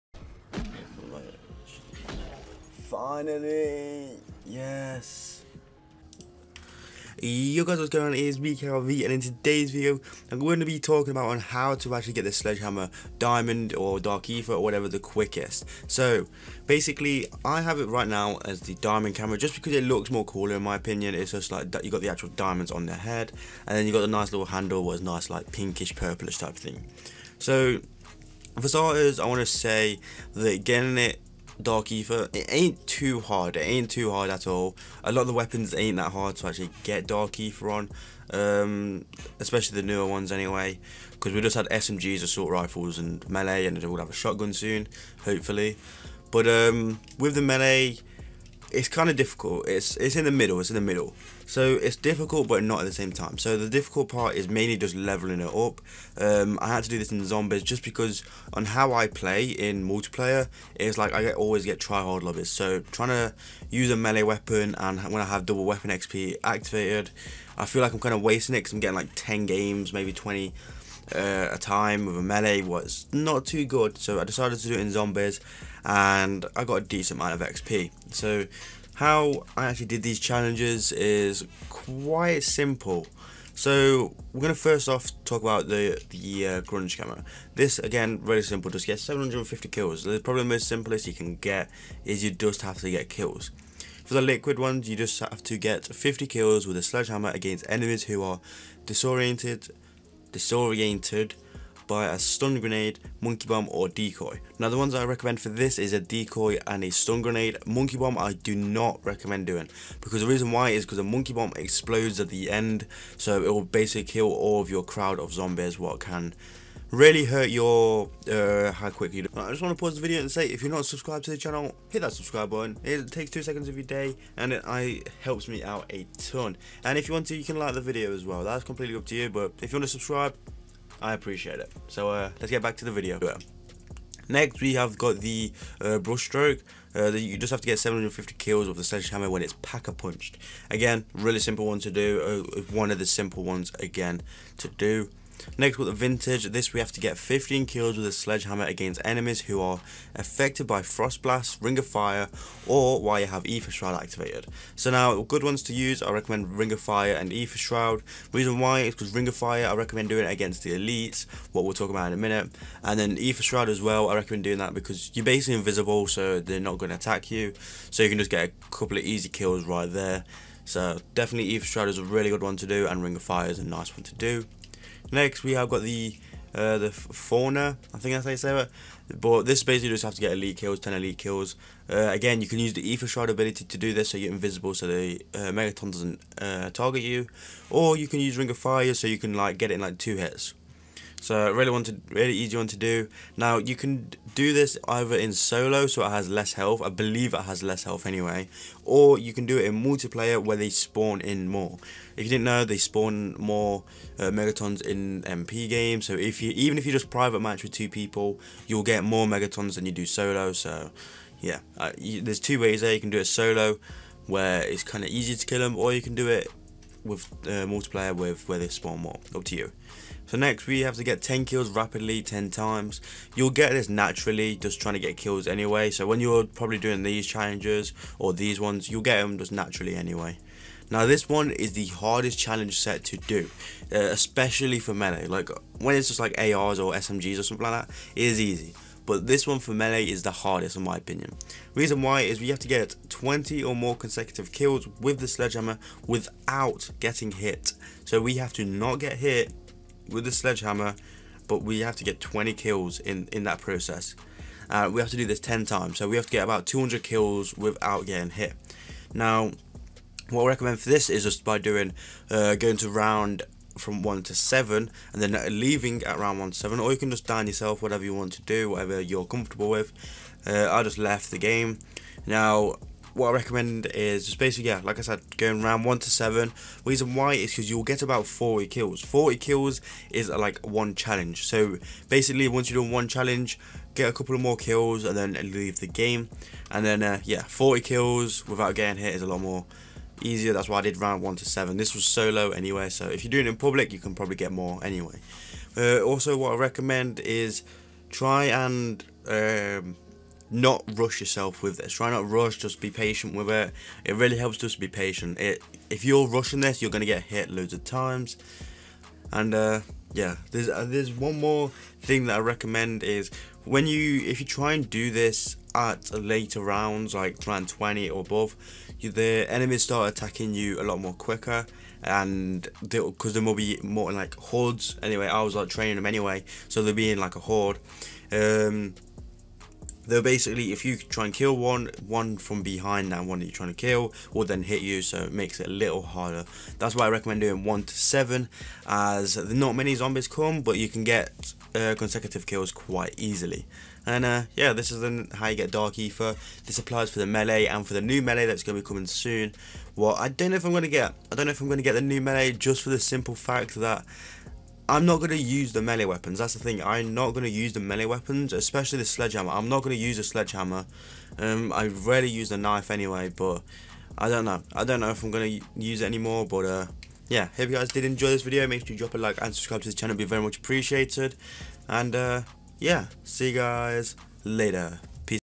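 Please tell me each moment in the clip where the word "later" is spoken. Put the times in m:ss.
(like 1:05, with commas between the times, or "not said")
5:16, 6:14.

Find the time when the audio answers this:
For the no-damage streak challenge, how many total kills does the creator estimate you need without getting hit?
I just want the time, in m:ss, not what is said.
4:16.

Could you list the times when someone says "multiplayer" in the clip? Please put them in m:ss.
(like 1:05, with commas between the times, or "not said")
0:59, 3:19, 3:37.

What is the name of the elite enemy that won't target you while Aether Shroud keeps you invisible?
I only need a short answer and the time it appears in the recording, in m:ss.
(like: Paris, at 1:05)
Megaton, at 3:05.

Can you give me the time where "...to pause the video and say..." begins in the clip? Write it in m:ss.
1:59.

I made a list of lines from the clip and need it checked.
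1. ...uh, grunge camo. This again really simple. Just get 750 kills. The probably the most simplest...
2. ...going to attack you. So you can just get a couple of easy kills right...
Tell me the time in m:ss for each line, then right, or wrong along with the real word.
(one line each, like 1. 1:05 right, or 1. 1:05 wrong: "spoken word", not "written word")
1. 1:26 right
2. 2:46 right.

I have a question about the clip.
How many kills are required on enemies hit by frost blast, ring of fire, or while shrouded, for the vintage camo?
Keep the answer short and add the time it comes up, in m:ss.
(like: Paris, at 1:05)
15, at 2:27.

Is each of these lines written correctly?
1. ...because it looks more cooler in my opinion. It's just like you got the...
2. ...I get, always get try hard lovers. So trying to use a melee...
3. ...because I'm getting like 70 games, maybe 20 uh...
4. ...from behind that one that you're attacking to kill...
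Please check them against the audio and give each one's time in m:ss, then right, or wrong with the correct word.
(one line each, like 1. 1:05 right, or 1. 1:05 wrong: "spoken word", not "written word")
1. 0:19 right
2. 1:01 right
3. 1:08 wrong: "10", not "70"
4. 5:32 wrong: "trying", not "attacking".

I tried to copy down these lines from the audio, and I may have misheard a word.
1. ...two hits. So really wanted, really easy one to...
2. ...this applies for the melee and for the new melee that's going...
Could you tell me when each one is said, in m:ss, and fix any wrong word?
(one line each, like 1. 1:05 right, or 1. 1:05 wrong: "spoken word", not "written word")
1. 3:09 right
2. 5:46 right.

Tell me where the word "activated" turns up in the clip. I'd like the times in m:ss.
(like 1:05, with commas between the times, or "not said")
1:06, 2:34.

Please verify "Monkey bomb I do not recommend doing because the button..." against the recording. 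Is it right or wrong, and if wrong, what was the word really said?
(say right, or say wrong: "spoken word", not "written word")
wrong: "reason", not "button".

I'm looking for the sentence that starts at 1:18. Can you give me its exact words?
So how I actually did these challenges is quite simple.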